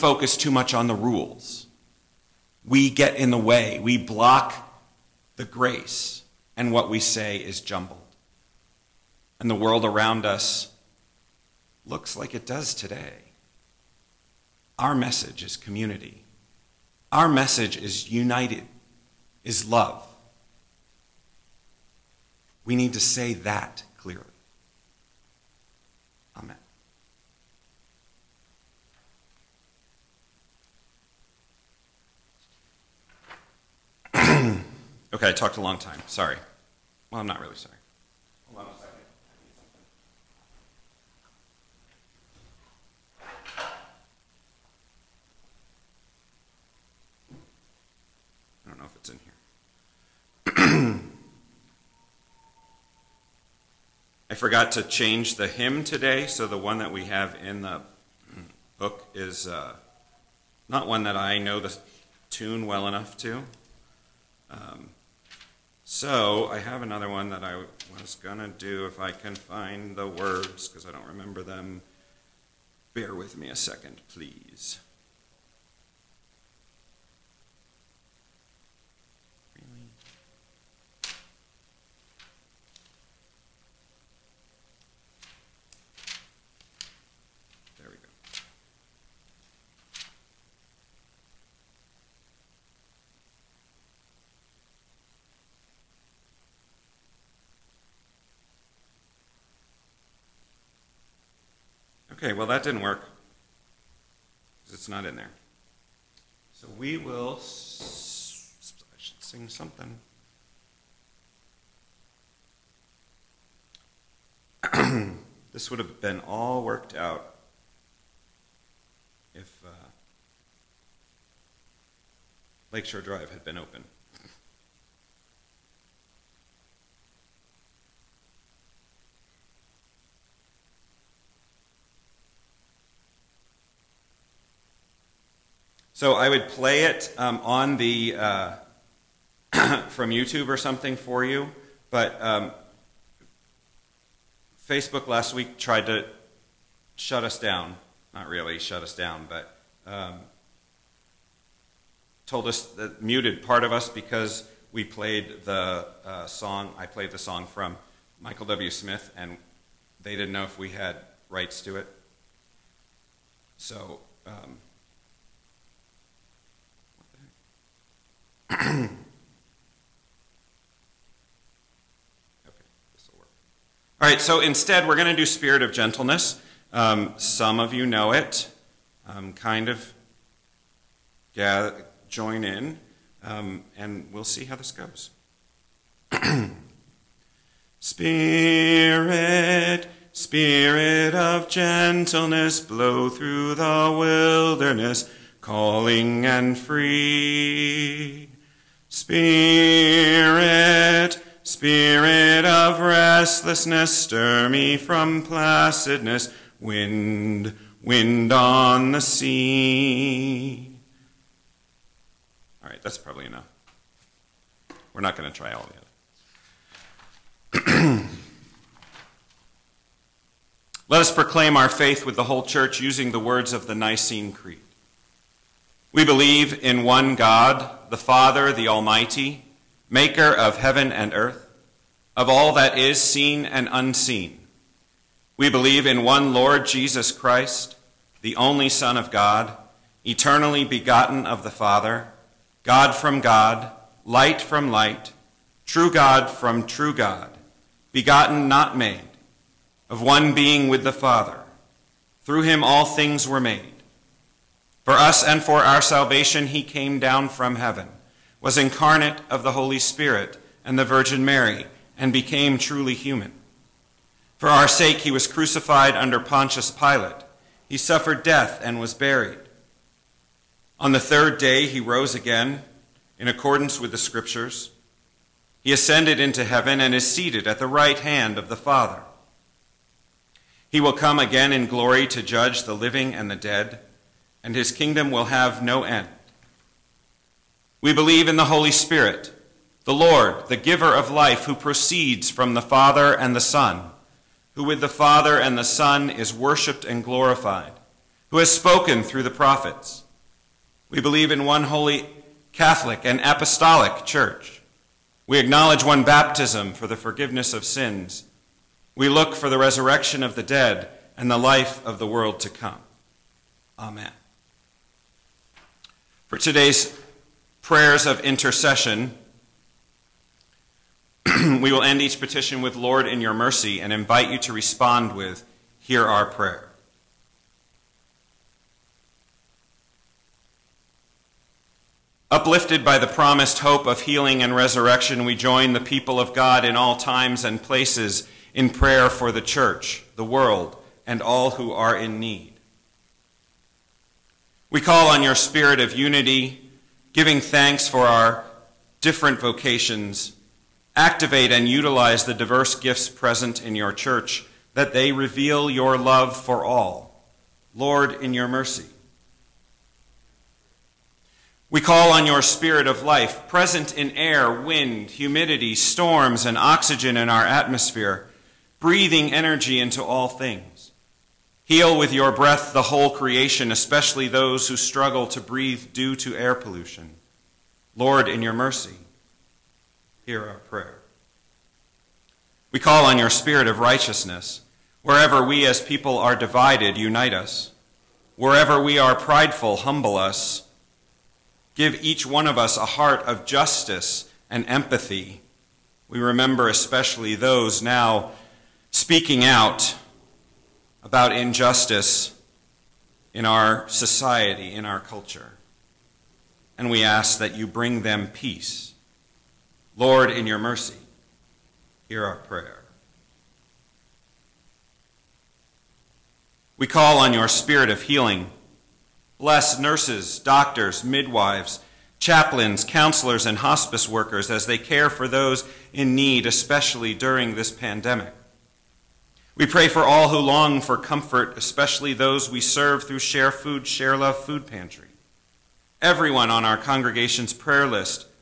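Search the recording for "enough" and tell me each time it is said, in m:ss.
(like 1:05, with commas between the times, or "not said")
1:02, 3:33.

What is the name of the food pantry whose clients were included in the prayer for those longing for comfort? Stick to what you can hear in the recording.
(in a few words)
Share Food, Share Love.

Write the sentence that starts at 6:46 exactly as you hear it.
And we ask that you bring them peace.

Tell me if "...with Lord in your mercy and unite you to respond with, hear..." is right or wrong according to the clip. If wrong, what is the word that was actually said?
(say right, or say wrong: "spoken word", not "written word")
wrong: "invite", not "unite".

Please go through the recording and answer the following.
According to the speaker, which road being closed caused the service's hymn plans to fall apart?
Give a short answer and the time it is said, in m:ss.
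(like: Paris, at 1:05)
Lakeshore Drive, at 2:02.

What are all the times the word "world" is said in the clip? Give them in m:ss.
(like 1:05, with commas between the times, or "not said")
0:09, 5:12, 5:40.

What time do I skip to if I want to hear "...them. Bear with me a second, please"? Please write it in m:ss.
1:11.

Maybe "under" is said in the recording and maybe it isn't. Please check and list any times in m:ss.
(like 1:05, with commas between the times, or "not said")
4:25.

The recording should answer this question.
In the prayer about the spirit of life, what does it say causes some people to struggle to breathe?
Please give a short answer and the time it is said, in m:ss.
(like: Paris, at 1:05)
Air pollution, at 6:16.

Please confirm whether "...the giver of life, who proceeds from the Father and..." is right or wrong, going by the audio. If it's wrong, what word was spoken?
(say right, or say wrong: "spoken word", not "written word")
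right.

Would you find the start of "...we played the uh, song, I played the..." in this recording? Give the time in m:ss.
2:34.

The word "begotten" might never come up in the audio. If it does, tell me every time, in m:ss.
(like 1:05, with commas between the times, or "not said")
4:00, 4:07.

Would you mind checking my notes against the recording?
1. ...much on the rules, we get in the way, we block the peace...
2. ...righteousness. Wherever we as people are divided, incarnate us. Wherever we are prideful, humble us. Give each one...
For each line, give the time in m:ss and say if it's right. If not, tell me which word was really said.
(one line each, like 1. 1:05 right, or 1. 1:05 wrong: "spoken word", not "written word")
1. 0:00 wrong: "grace", not "peace"
2. 6:23 wrong: "unite", not "incarnate".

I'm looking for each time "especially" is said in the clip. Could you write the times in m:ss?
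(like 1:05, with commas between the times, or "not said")
6:13, 6:36, 7:06, 7:11.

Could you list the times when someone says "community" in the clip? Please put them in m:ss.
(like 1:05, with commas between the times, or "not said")
0:15.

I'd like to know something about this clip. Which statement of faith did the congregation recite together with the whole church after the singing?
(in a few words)
Nicene Creed.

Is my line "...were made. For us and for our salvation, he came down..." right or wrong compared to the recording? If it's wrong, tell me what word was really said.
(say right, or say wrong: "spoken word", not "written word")
right.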